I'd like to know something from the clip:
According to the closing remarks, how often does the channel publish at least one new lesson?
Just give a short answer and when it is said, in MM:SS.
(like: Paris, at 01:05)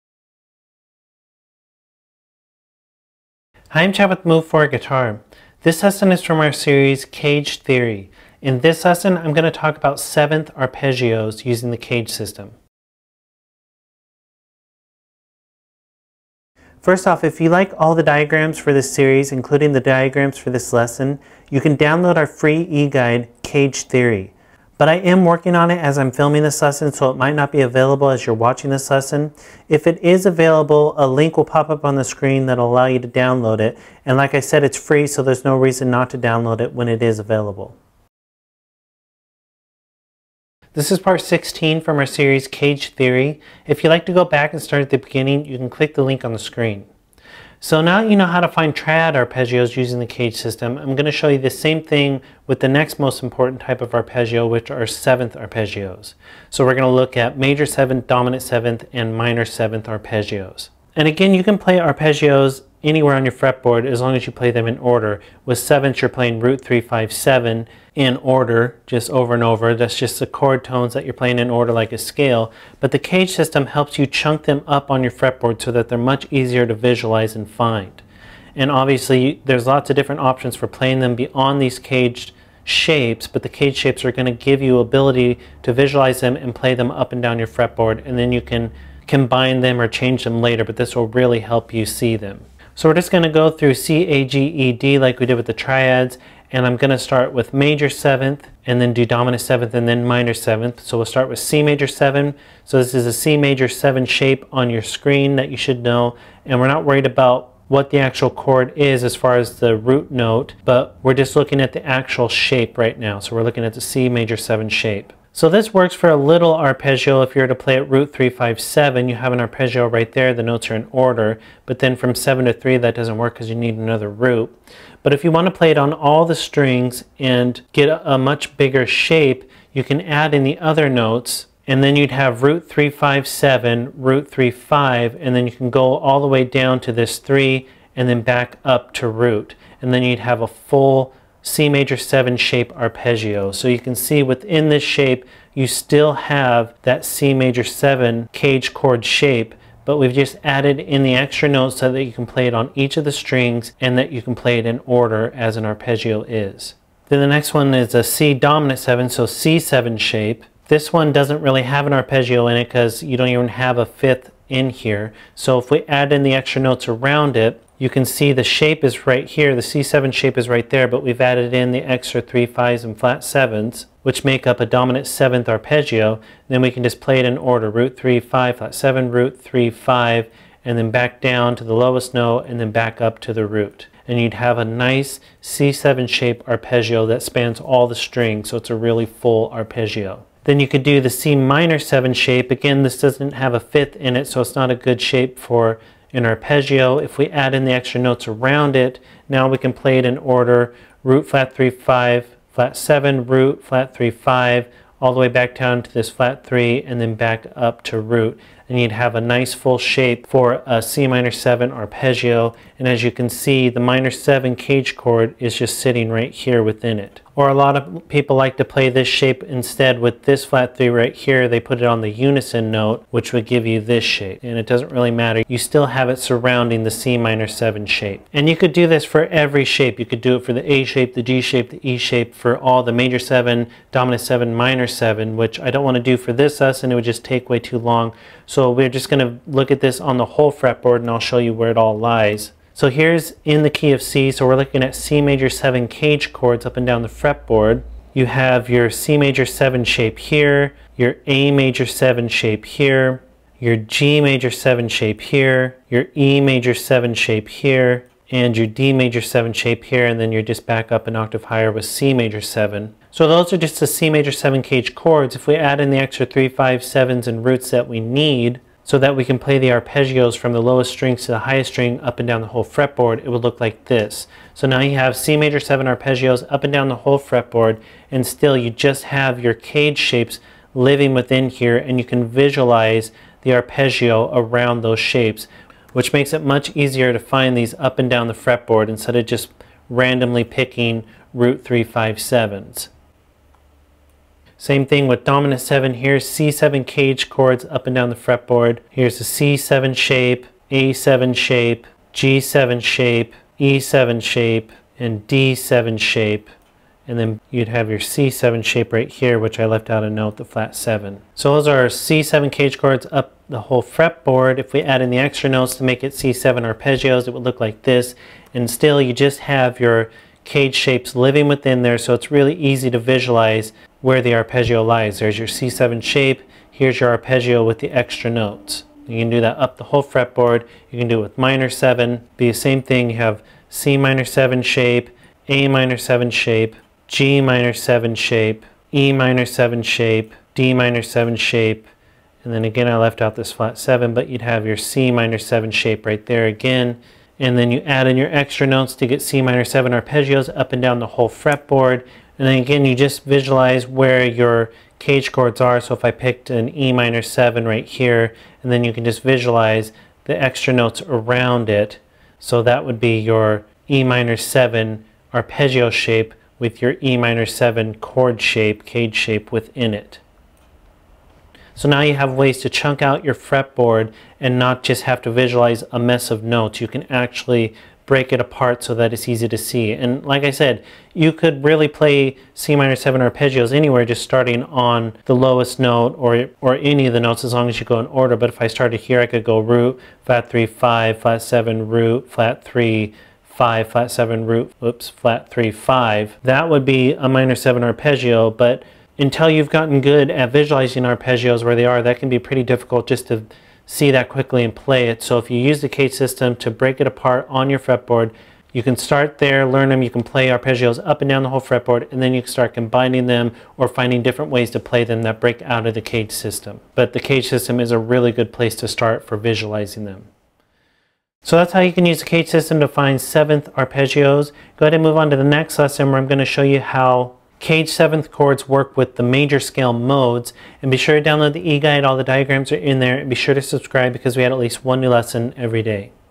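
Every day, at 07:15.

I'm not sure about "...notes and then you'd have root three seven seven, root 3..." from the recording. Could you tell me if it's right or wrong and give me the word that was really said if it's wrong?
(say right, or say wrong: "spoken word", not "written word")
wrong: "five", not "seven".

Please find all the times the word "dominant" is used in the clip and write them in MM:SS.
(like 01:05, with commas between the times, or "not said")
00:58, 01:39, 02:38, 02:54, 03:53, 04:55.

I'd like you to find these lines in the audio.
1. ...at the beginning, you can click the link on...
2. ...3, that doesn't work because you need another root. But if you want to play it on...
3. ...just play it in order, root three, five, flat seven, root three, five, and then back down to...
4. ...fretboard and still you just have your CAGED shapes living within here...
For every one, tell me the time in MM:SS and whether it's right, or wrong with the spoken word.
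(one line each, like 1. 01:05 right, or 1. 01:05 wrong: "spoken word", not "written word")
1. 00:44 right
2. 02:02 right
3. 02:56 right
4. 04:37 right.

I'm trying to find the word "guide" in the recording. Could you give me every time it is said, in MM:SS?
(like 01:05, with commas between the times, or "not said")
00:22, 07:11.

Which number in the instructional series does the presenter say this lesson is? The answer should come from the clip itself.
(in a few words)
16.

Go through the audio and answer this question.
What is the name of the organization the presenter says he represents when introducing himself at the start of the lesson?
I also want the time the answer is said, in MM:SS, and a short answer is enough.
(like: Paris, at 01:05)
Move Forward Guitar, at 00:04.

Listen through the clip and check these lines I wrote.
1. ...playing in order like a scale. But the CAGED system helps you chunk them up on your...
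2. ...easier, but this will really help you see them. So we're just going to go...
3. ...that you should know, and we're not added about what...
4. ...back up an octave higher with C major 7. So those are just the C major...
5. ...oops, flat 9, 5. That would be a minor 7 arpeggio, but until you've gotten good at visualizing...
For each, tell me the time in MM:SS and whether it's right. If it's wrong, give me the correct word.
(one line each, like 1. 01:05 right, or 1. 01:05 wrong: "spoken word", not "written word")
1. 01:11 right
2. 01:30 wrong: "later", not "easier"
3. 01:45 wrong: "worried", not "added"
4. 04:20 right
5. 06:34 wrong: "3", not "9".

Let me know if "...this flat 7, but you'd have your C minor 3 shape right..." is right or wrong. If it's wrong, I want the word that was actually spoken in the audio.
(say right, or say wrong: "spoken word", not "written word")
wrong: "7", not "3".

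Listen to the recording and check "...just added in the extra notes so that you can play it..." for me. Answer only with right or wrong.
right.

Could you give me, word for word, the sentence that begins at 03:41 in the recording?
They put it on the unison note, which would give you this shape.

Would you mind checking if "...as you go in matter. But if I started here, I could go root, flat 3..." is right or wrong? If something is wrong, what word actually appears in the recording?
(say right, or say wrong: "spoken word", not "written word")
wrong: "order", not "matter".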